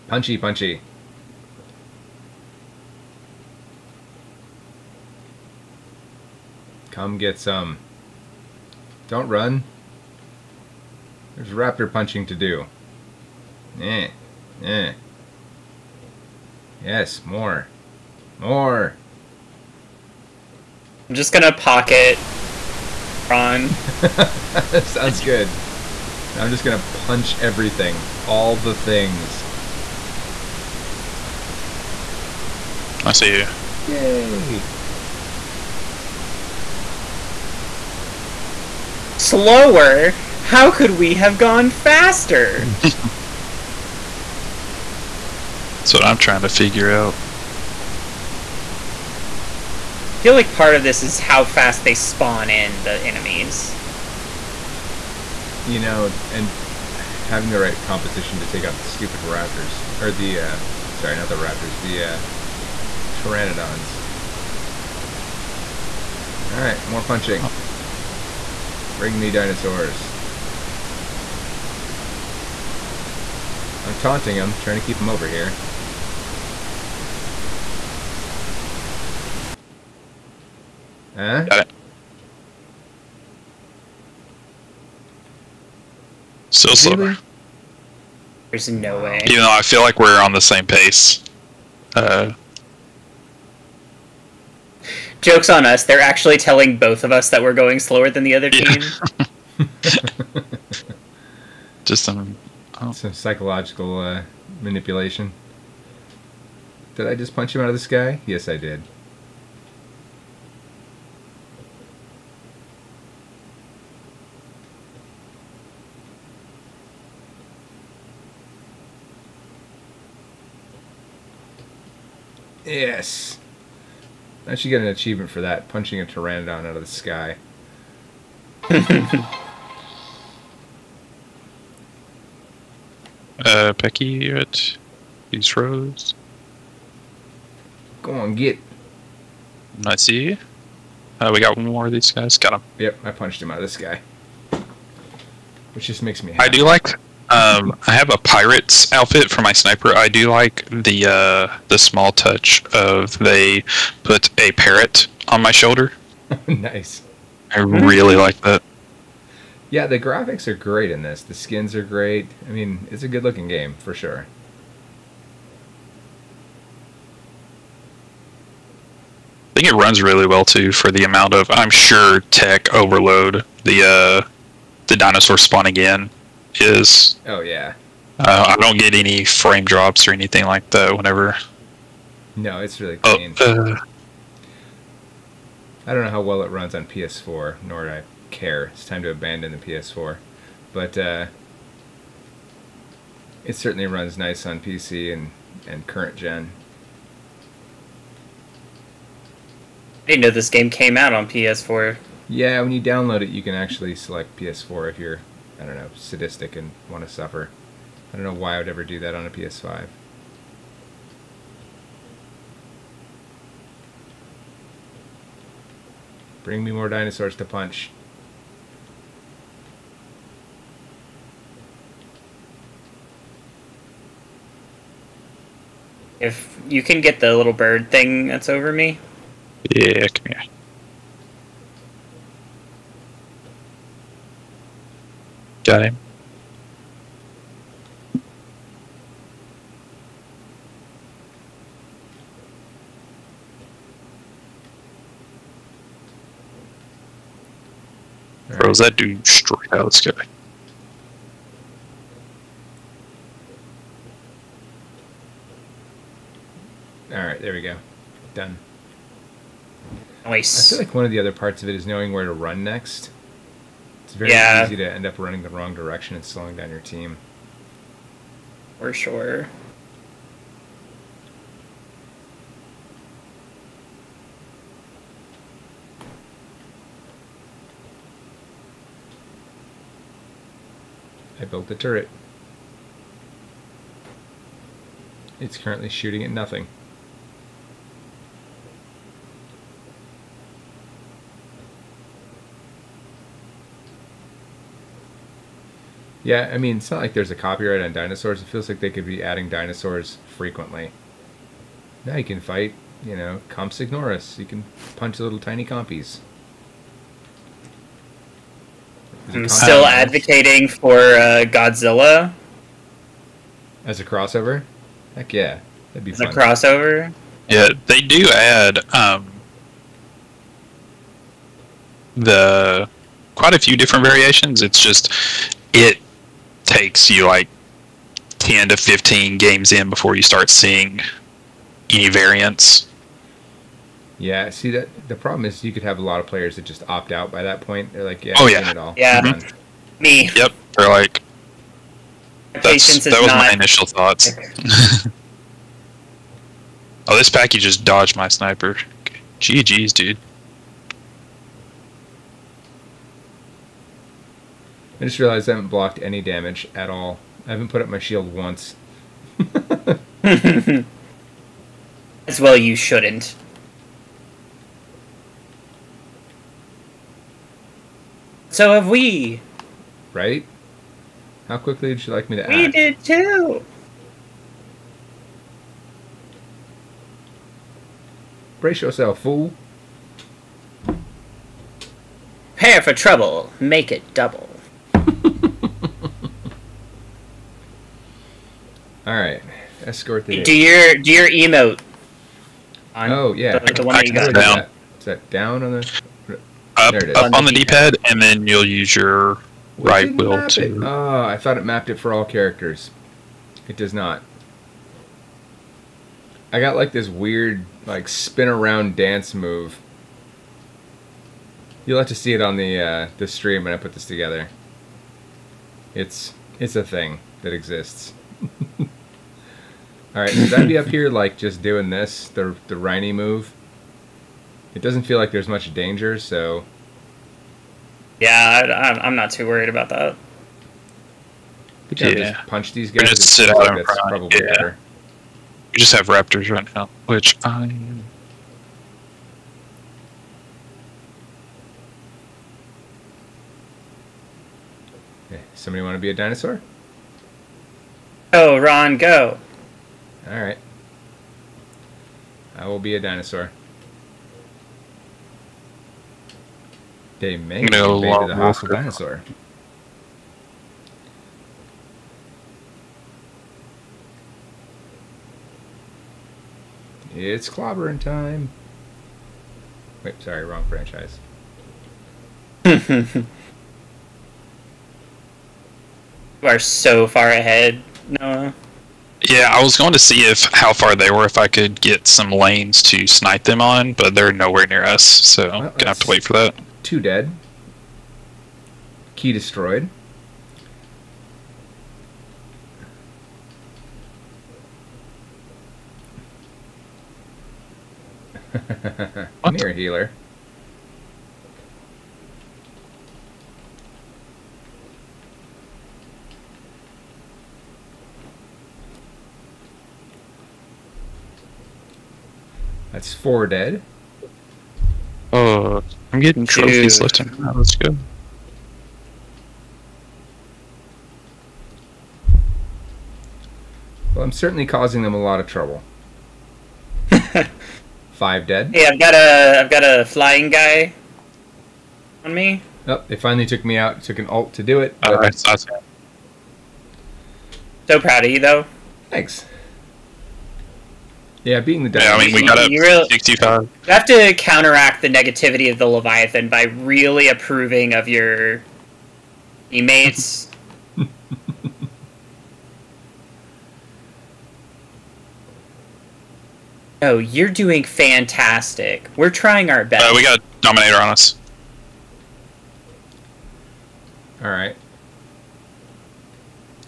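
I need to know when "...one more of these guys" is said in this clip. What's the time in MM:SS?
02:21.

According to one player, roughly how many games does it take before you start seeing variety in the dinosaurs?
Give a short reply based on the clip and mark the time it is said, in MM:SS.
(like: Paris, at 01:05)
10 to 15, at 05:28.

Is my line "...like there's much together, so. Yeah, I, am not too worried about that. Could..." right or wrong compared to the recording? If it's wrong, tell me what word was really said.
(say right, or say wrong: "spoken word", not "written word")
wrong: "danger", not "together".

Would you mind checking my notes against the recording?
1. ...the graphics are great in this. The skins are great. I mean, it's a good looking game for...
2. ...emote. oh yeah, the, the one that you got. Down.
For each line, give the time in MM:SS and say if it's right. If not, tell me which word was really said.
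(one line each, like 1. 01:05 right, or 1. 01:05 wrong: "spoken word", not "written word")
1. 02:39 right
2. 06:31 right.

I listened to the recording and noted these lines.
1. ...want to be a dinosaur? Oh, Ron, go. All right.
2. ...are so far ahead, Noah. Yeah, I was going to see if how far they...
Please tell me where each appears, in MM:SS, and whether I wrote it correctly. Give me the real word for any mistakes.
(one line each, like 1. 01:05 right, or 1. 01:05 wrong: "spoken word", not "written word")
1. 07:25 right
2. 07:56 right.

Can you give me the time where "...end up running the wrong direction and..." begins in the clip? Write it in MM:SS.
04:24.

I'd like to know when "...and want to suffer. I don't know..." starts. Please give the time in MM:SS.
03:26.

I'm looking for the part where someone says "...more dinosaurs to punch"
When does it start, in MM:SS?
03:36.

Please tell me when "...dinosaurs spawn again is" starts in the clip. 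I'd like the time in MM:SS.
02:54.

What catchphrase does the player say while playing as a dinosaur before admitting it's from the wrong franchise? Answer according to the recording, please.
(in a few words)
It's clobbering time.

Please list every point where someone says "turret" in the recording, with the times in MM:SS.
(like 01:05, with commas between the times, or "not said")
04:41.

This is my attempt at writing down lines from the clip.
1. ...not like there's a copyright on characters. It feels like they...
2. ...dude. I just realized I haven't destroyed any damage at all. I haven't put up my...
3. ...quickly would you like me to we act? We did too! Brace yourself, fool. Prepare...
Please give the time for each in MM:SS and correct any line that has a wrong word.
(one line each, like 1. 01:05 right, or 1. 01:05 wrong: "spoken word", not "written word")
1. 04:56 wrong: "dinosaurs", not "characters"
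2. 05:49 wrong: "blocked", not "destroyed"
3. 06:11 right.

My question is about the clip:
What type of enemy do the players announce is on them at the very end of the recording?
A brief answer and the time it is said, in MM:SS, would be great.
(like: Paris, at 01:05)
Dominator, at 09:20.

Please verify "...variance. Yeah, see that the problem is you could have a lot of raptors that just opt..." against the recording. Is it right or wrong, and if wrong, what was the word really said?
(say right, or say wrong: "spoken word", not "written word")
wrong: "players", not "raptors".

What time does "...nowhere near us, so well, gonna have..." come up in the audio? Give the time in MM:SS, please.
08:04.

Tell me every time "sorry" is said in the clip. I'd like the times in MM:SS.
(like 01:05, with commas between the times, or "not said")
01:00, 07:50.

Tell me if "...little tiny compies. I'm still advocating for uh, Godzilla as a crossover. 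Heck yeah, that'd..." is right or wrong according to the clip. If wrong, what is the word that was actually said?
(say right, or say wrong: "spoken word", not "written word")
right.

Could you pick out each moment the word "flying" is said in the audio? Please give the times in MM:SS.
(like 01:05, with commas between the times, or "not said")
08:50.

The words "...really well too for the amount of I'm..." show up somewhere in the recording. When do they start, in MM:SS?
02:50.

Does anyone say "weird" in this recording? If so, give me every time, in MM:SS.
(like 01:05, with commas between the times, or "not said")
06:47.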